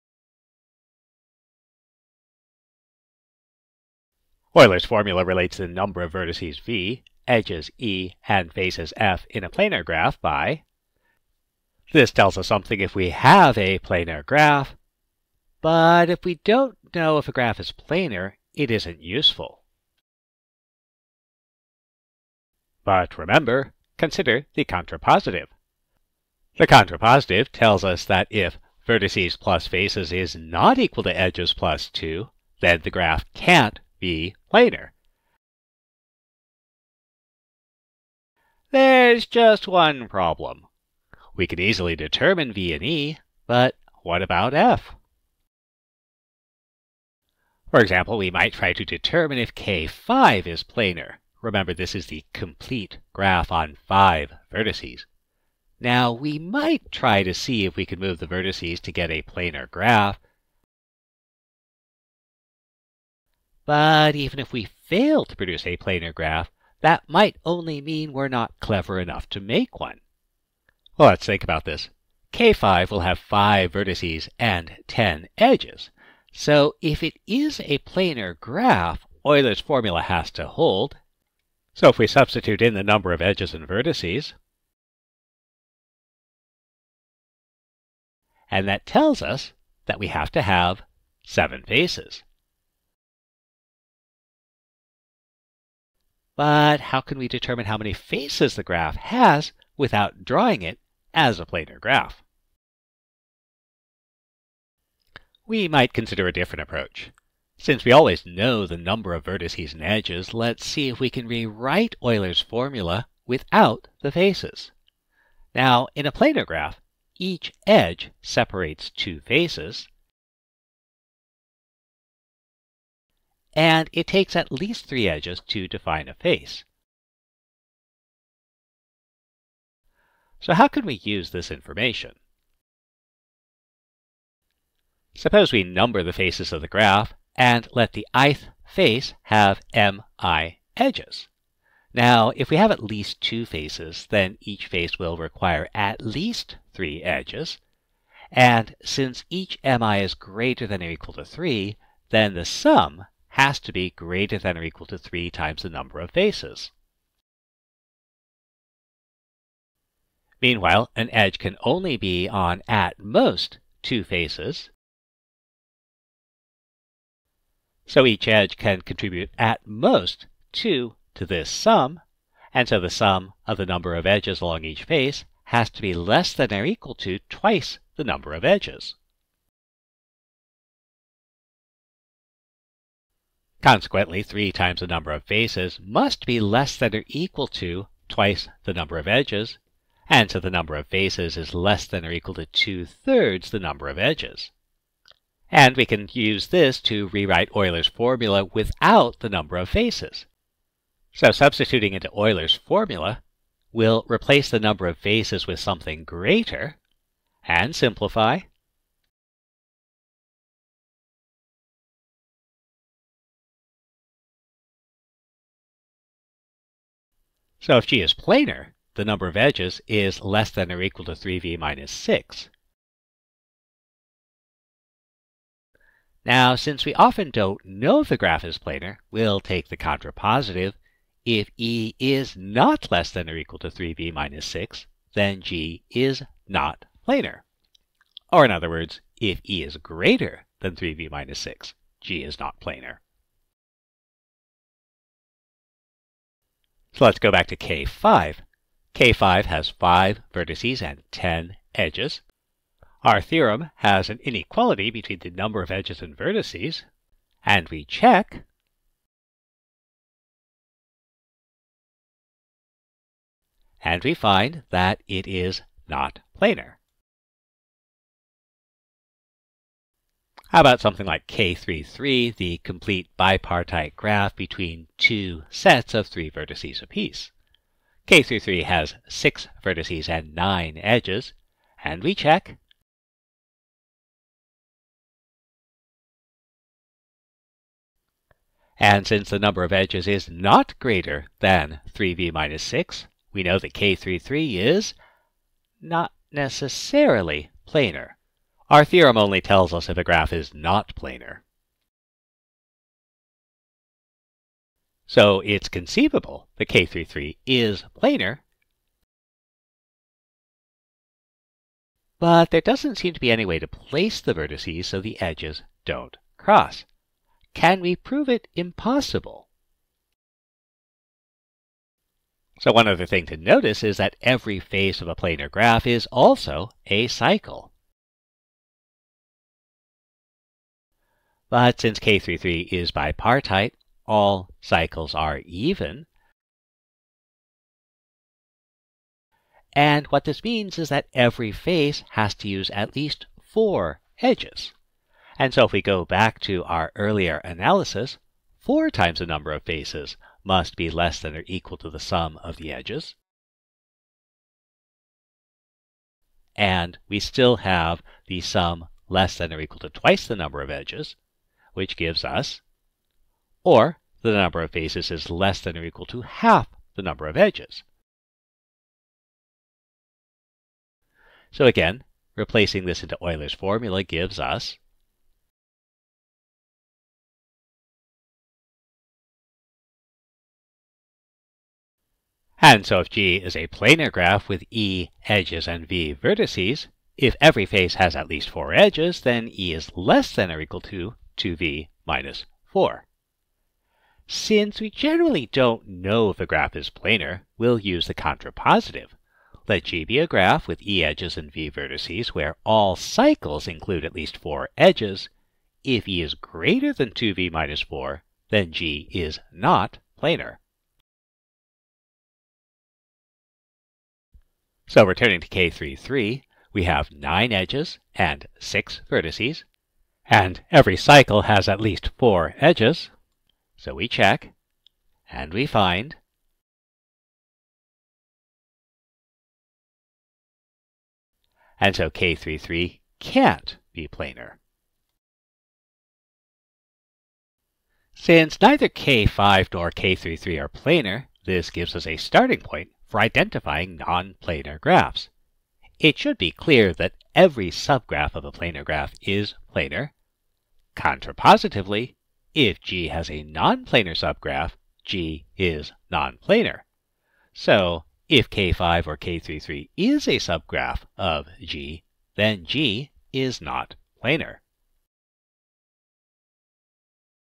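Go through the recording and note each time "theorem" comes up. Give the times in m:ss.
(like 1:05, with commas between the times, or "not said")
4:13, 4:58.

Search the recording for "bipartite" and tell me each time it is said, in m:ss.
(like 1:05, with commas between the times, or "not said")
4:33, 5:32.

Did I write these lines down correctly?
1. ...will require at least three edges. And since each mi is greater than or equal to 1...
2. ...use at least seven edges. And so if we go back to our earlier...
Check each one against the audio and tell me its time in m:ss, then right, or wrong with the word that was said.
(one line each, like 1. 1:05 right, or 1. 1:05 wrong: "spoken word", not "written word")
1. 2:24 wrong: "3", not "1"
2. 5:42 wrong: "four", not "seven".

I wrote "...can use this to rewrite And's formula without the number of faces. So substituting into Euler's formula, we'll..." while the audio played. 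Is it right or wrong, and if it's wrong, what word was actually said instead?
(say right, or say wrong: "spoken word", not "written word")
wrong: "Euler", not "And".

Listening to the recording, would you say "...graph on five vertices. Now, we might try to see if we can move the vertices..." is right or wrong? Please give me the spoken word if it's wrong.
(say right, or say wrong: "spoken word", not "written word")
right.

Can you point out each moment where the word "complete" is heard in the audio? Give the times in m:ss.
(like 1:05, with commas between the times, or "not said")
0:52, 4:32.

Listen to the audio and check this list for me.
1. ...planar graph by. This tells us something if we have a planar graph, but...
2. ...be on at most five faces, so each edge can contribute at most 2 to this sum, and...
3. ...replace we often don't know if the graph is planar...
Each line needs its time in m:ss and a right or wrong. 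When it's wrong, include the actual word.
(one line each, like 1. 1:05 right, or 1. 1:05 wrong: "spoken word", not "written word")
1. 0:09 right
2. 2:41 wrong: "two", not "five"
3. 3:46 wrong: "since", not "replace".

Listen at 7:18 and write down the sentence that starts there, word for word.
Since neither K5 nor K33 are planar, this gives us a starting point for identifying non-planar graphs.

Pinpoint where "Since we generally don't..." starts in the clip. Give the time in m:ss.
6:34.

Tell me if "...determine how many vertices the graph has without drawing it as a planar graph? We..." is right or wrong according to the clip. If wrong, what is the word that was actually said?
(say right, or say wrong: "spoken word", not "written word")
wrong: "faces", not "vertices".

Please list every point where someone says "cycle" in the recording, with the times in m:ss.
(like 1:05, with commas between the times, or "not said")
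5:27, 5:34, 6:42, 7:00.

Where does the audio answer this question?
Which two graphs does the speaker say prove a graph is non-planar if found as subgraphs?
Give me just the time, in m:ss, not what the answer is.
7:38.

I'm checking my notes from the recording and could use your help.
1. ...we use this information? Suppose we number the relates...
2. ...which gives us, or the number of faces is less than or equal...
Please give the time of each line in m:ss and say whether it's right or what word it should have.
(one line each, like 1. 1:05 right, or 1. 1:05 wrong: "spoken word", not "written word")
1. 2:10 wrong: "faces", not "relates"
2. 6:01 right.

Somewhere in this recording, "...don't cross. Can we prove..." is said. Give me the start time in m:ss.
5:15.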